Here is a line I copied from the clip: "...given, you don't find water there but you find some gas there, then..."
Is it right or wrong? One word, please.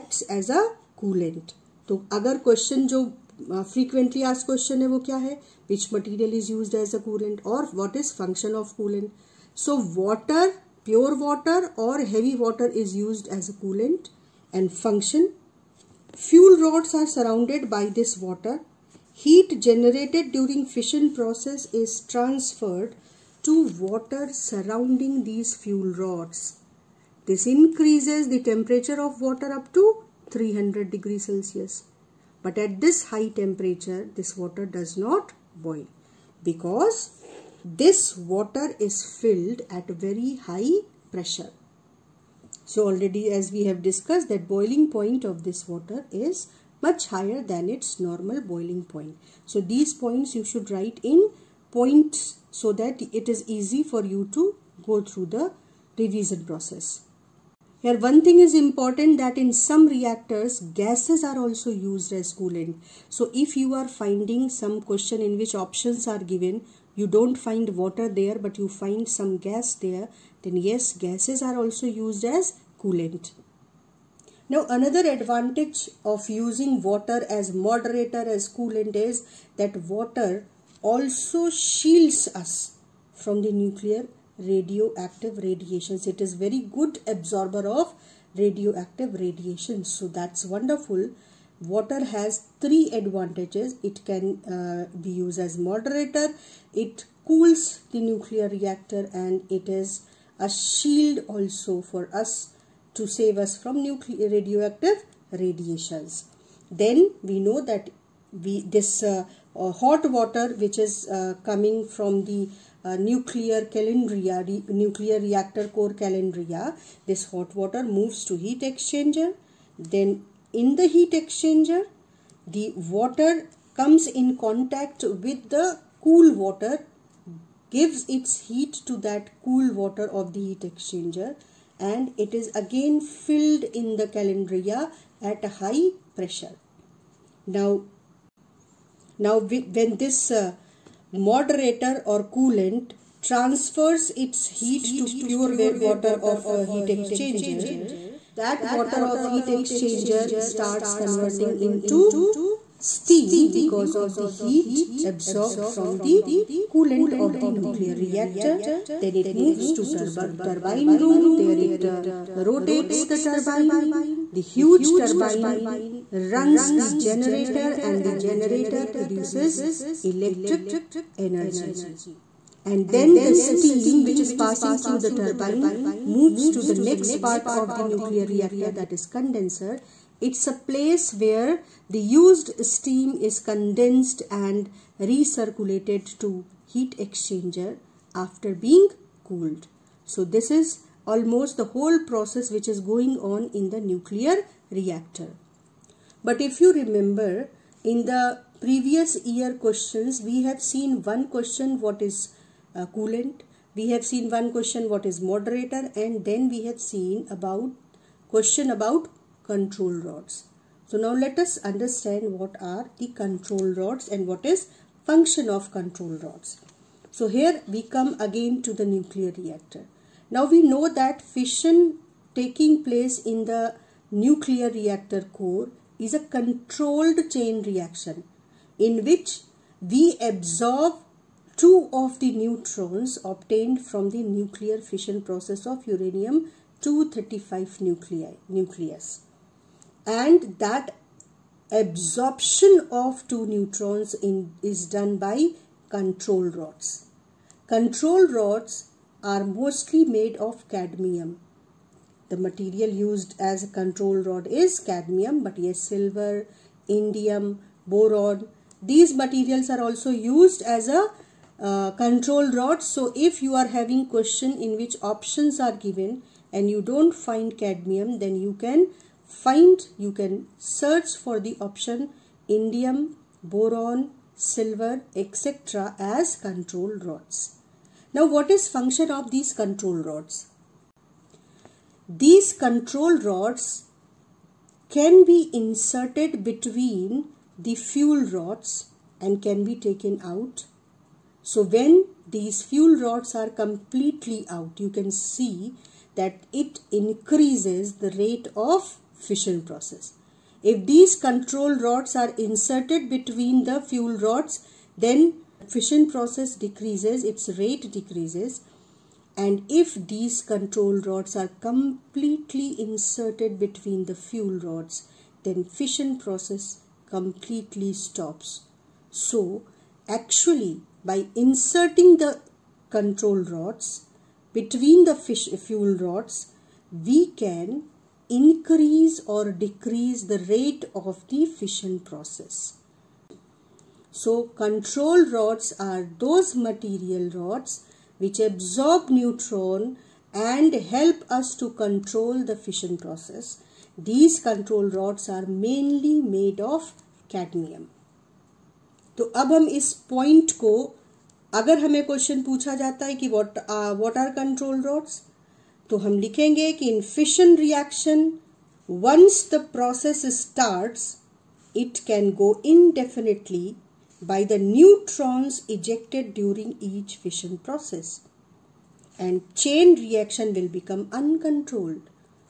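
right.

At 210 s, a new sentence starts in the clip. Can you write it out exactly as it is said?
So now let us understand what are the control rods and what is function of control rods.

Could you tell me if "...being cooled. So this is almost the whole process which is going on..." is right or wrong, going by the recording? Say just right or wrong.
right.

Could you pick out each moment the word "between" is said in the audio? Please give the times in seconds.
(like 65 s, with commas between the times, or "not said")
286 s, 303 s, 313 s, 324 s.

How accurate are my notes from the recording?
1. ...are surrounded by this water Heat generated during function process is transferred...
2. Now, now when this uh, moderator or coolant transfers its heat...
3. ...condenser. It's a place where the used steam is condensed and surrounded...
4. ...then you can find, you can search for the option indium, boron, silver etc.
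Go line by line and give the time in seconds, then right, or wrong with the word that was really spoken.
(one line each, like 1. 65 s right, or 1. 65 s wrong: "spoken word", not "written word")
1. 16 s wrong: "fission", not "function"
2. 137 s right
3. 179 s wrong: "recirculated", not "surrounded"
4. 268 s right.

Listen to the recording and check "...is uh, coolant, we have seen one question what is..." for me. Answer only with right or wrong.
right.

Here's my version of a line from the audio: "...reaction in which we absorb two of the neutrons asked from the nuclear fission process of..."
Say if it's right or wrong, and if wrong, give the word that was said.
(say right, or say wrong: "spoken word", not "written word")
wrong: "obtained", not "asked".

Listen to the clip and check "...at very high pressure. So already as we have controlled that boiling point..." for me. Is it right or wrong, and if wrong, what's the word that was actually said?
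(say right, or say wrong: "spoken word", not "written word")
wrong: "discussed", not "controlled".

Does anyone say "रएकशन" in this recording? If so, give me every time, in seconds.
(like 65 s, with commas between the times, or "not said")
357 s, 369 s.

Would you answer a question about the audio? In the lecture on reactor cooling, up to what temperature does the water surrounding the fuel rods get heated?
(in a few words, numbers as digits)
300 degrees Celsius.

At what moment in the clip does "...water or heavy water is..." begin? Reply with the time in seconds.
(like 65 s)
11 s.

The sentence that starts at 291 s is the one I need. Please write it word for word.
So when these fuel rods are completely out, you can see that it increases the rate of fission process.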